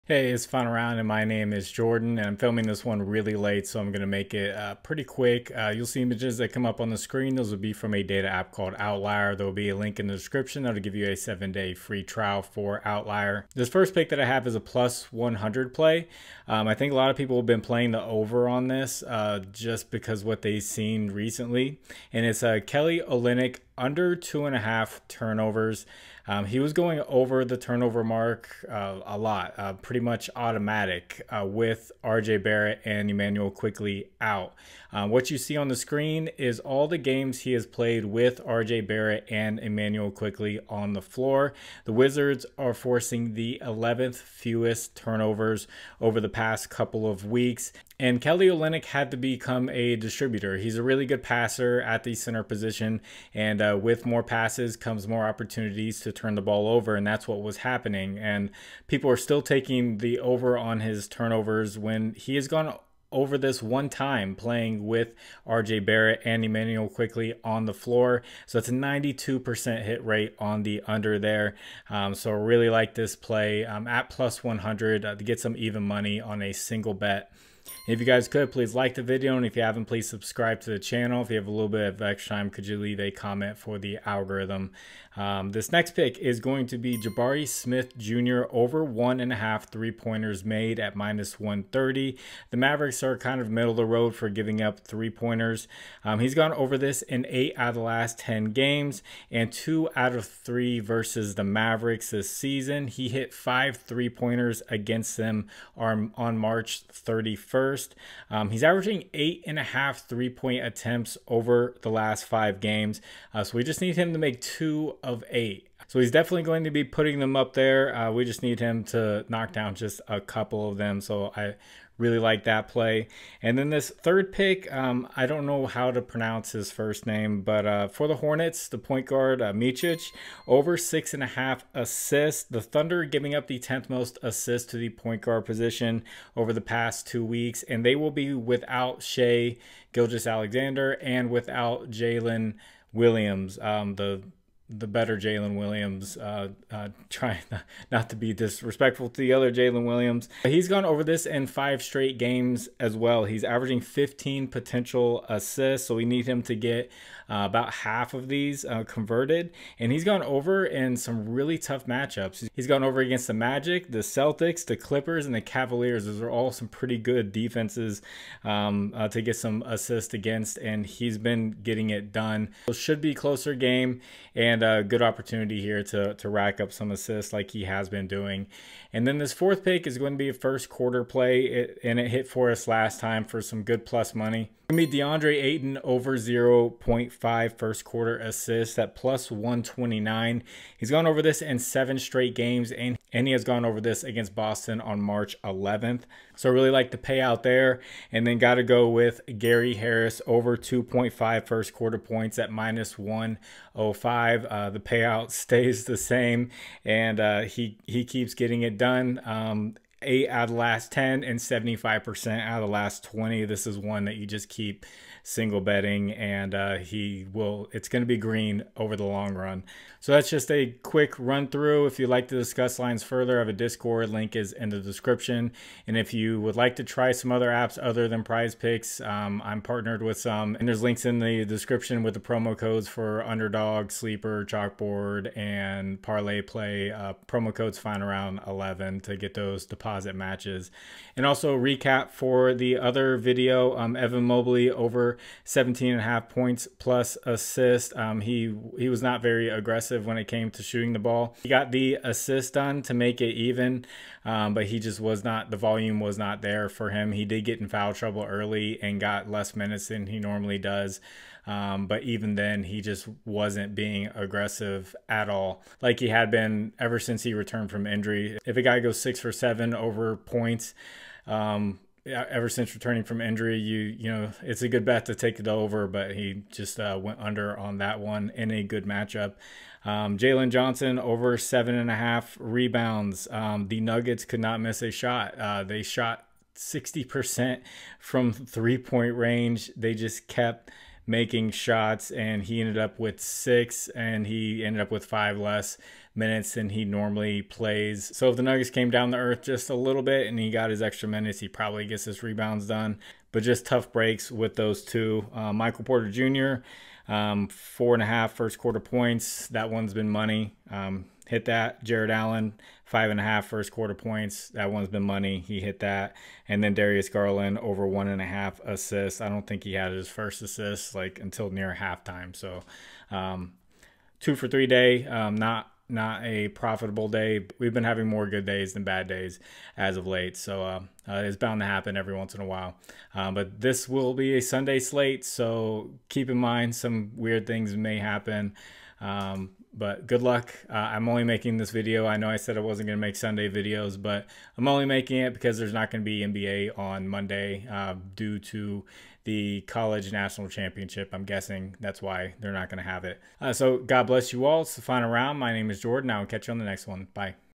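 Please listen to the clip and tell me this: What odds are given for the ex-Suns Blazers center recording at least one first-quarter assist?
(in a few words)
+129.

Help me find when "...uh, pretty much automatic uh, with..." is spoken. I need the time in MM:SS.
00:29.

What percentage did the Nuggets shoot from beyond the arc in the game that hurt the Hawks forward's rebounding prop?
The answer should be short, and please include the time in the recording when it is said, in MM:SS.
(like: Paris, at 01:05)
60%, at 04:46.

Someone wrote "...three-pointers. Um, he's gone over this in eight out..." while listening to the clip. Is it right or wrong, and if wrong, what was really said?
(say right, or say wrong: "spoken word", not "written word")
right.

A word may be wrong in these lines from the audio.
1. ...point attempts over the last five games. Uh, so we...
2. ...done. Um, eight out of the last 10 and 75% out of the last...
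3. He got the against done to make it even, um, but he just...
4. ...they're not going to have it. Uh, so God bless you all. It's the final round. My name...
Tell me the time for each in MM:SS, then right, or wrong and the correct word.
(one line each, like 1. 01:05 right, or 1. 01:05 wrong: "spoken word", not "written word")
1. 01:50 right
2. 03:28 right
3. 04:11 wrong: "assist", not "against"
4. 05:52 right.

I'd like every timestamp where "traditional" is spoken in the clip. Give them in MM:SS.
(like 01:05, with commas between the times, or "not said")
not said.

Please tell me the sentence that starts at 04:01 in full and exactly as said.
And also recap for the other video, um, Evan Mobley over 17 and a half points plus assist.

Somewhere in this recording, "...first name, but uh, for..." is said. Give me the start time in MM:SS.
02:06.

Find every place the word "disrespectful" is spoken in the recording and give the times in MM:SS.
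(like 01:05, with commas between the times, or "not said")
02:28.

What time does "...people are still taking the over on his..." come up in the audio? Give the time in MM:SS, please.
00:58.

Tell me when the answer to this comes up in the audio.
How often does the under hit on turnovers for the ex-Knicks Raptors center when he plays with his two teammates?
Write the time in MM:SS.
01:08.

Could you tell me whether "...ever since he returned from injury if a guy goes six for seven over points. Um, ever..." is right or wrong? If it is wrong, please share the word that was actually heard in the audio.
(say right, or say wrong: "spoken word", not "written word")
right.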